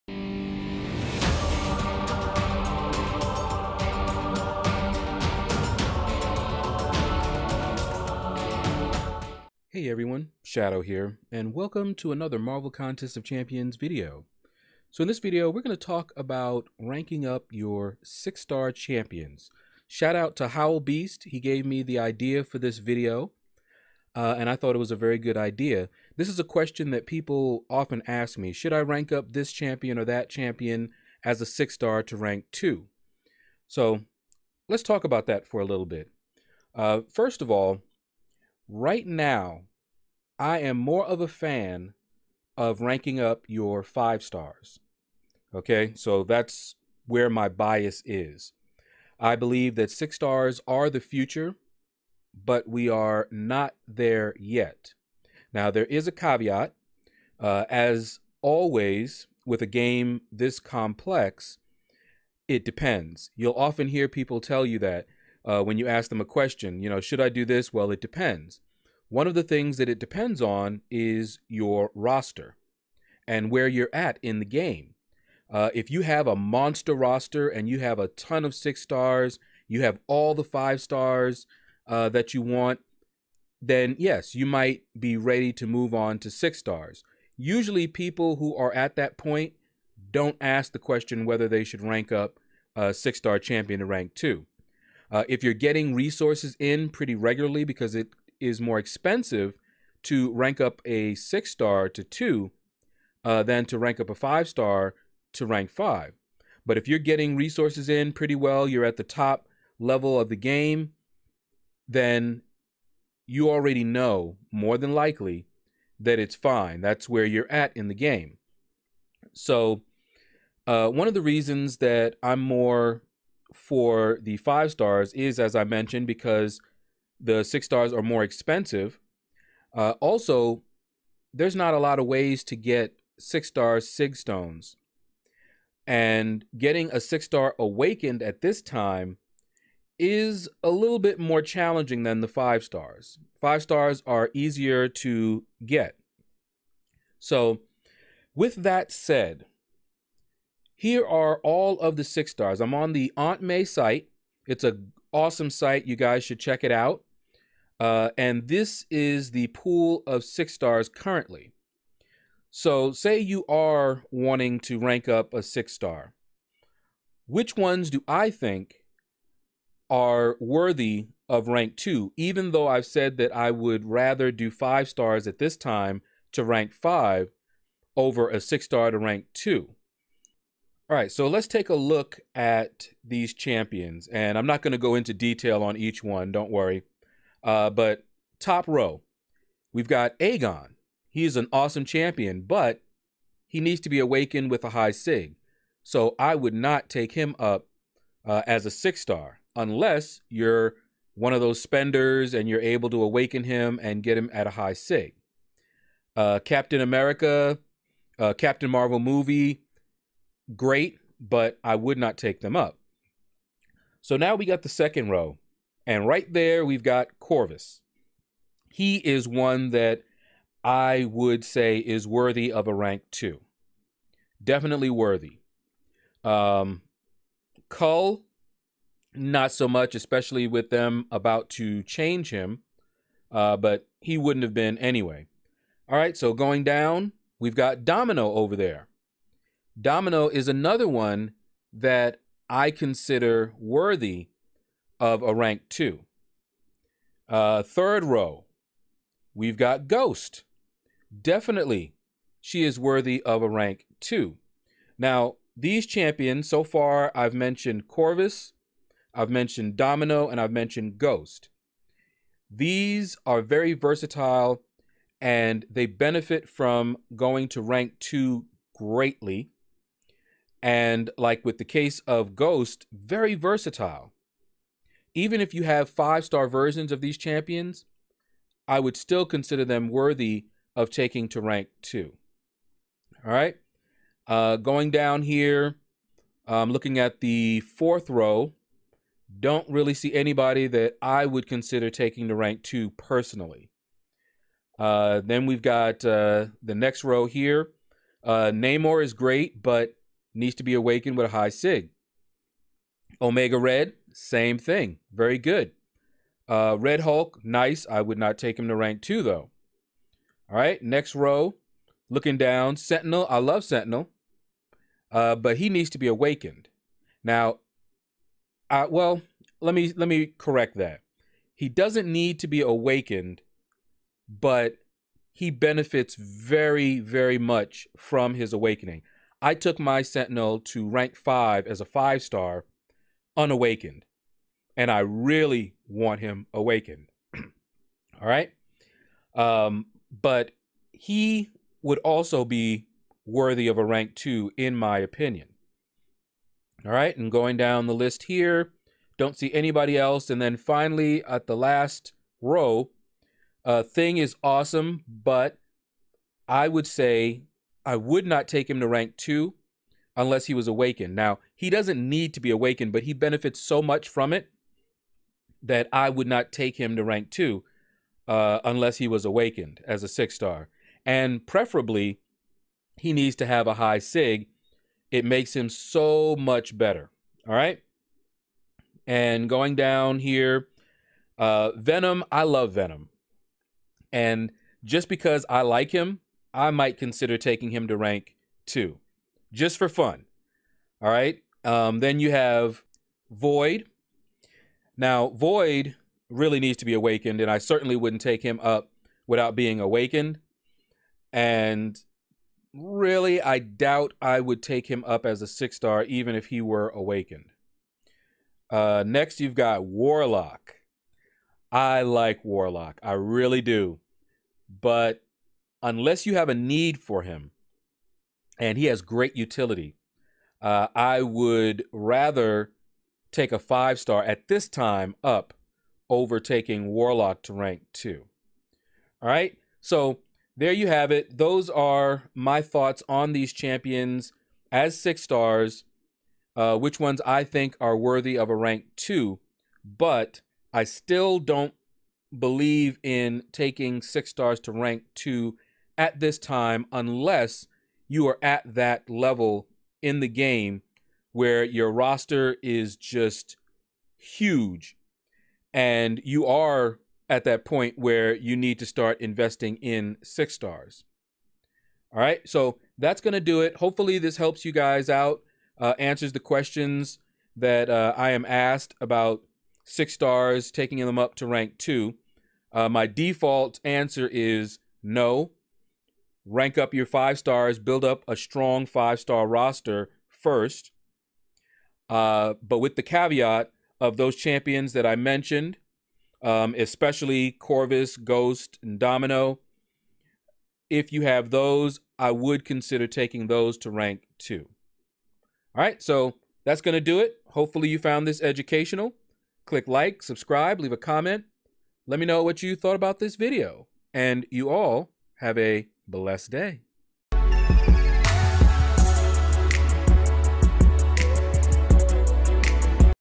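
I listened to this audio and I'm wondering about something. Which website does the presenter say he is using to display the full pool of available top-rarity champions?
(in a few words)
Aunt May site.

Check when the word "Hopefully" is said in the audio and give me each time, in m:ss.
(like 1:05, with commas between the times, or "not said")
7:43, 8:17.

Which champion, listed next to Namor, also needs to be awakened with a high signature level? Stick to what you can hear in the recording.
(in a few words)
Omega Red.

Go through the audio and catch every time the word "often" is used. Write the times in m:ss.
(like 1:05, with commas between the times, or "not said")
0:27, 1:03.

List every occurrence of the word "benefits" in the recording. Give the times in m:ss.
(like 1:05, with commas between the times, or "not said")
4:25, 5:25, 6:03.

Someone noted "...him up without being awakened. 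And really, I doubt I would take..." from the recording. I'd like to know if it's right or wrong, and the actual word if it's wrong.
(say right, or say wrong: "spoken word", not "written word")
right.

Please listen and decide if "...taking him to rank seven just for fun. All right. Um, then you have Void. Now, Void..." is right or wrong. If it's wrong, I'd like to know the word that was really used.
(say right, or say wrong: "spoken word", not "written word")
wrong: "two", not "seven".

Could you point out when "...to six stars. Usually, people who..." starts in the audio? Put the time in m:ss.
1:26.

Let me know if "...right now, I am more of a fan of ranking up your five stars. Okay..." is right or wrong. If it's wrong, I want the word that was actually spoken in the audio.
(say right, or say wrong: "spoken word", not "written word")
right.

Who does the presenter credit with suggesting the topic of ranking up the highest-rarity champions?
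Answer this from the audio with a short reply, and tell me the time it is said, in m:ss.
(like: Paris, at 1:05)
Howl Beast, at 0:20.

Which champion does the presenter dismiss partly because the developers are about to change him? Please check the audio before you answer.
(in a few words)
Cull.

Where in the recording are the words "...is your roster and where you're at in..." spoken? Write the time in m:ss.
1:10.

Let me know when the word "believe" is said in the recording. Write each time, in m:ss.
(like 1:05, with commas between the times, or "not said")
0:49, 7:22.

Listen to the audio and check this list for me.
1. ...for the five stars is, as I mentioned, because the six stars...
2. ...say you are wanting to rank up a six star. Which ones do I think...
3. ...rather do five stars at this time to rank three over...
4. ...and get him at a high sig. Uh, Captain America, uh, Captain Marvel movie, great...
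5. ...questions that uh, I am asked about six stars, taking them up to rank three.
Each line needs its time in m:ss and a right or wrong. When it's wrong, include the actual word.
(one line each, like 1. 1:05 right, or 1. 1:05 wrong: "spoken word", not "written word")
1. 2:03 right
2. 2:42 right
3. 2:53 wrong: "five", not "three"
4. 3:23 right
5. 7:46 wrong: "two", not "three".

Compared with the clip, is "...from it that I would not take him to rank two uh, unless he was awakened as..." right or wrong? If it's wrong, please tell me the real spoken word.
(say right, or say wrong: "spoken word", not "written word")
right.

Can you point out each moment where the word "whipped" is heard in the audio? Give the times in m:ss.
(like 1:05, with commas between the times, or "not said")
not said.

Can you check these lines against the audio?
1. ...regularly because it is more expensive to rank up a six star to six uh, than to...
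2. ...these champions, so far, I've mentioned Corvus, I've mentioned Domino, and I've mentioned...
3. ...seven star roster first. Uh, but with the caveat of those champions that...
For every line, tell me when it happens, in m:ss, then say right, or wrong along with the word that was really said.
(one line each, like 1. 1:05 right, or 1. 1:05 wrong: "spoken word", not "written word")
1. 1:37 wrong: "two", not "six"
2. 4:15 right
3. 7:58 wrong: "five", not "seven".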